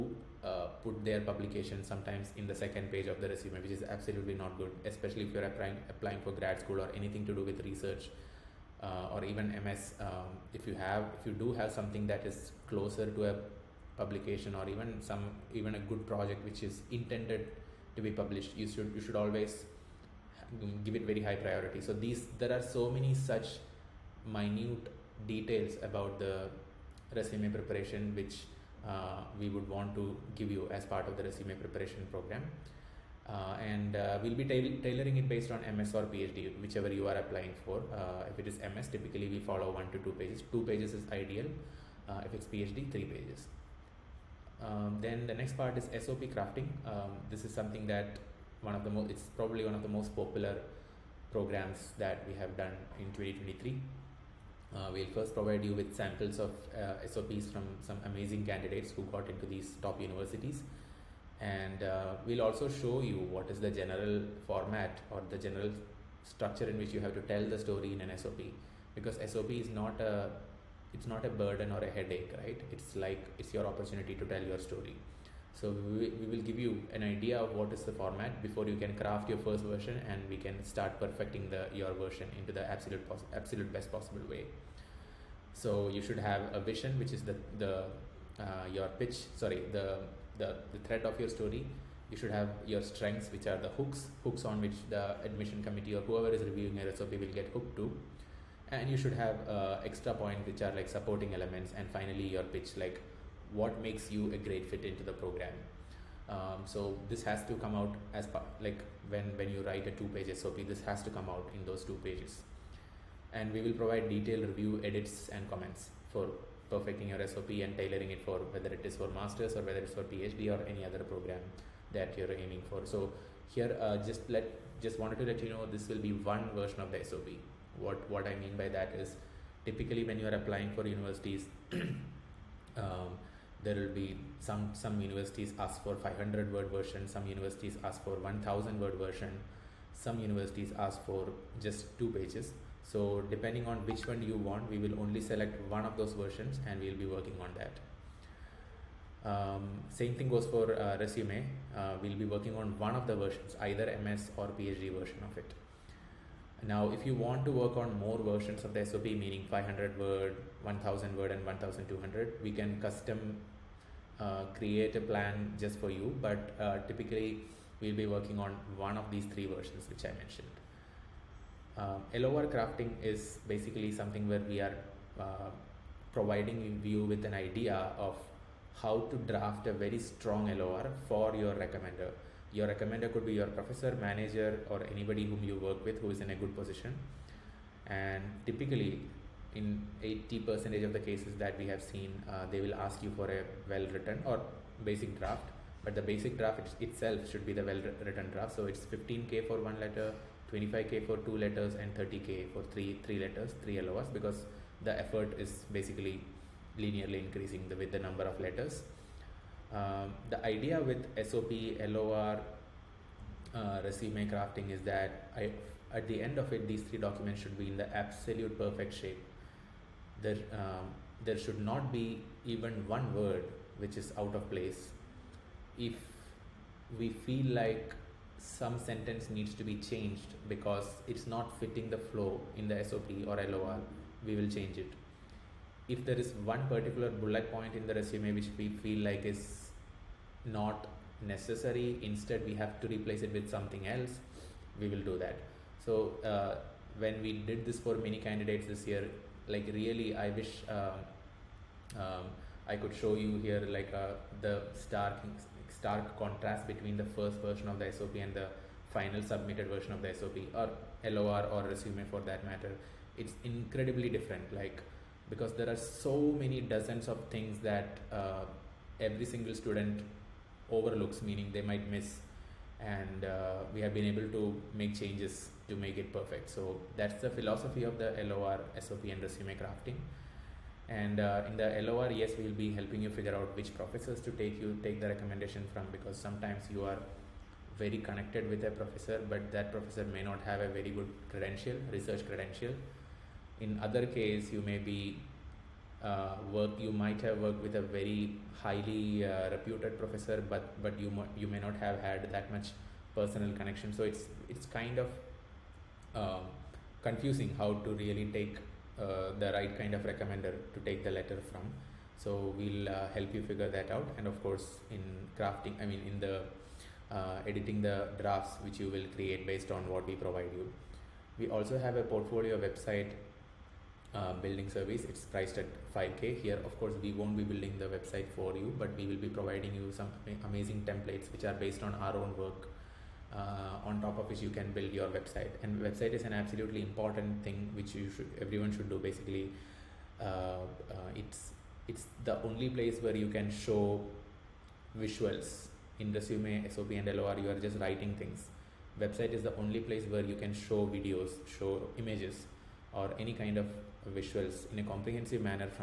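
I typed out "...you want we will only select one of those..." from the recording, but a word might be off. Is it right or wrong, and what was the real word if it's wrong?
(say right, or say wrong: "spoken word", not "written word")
right.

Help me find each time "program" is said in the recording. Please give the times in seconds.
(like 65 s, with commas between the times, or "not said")
32 s, 51 s, 105 s, 120 s.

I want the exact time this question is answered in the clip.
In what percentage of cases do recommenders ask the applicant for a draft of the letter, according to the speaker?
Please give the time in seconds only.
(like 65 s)
190 s.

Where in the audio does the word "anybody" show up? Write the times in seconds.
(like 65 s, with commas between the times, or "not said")
184 s.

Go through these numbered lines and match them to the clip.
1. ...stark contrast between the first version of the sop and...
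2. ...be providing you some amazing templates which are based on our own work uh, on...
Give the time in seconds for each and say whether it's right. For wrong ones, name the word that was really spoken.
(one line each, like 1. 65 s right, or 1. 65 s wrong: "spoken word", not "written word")
1. 255 s right
2. 329 s right.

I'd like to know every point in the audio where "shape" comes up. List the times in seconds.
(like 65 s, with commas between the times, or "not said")
218 s.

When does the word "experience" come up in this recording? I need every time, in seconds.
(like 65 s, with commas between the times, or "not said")
not said.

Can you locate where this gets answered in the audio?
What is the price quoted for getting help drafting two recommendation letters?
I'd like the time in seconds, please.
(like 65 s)
200 s.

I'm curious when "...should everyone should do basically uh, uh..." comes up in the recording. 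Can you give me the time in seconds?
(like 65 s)
338 s.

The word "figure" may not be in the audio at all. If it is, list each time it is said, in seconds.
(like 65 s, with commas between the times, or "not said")
283 s, 313 s.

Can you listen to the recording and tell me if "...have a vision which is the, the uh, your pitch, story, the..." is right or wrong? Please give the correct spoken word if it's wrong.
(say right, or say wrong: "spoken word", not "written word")
wrong: "sorry", not "story".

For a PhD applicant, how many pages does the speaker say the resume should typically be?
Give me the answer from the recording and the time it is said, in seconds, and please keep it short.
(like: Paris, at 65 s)
3 pages, at 42 s.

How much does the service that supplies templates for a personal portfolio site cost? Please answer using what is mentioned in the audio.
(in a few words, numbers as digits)
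5k.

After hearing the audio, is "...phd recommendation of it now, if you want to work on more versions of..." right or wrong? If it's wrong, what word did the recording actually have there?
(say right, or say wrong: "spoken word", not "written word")
wrong: "version", not "recommendation".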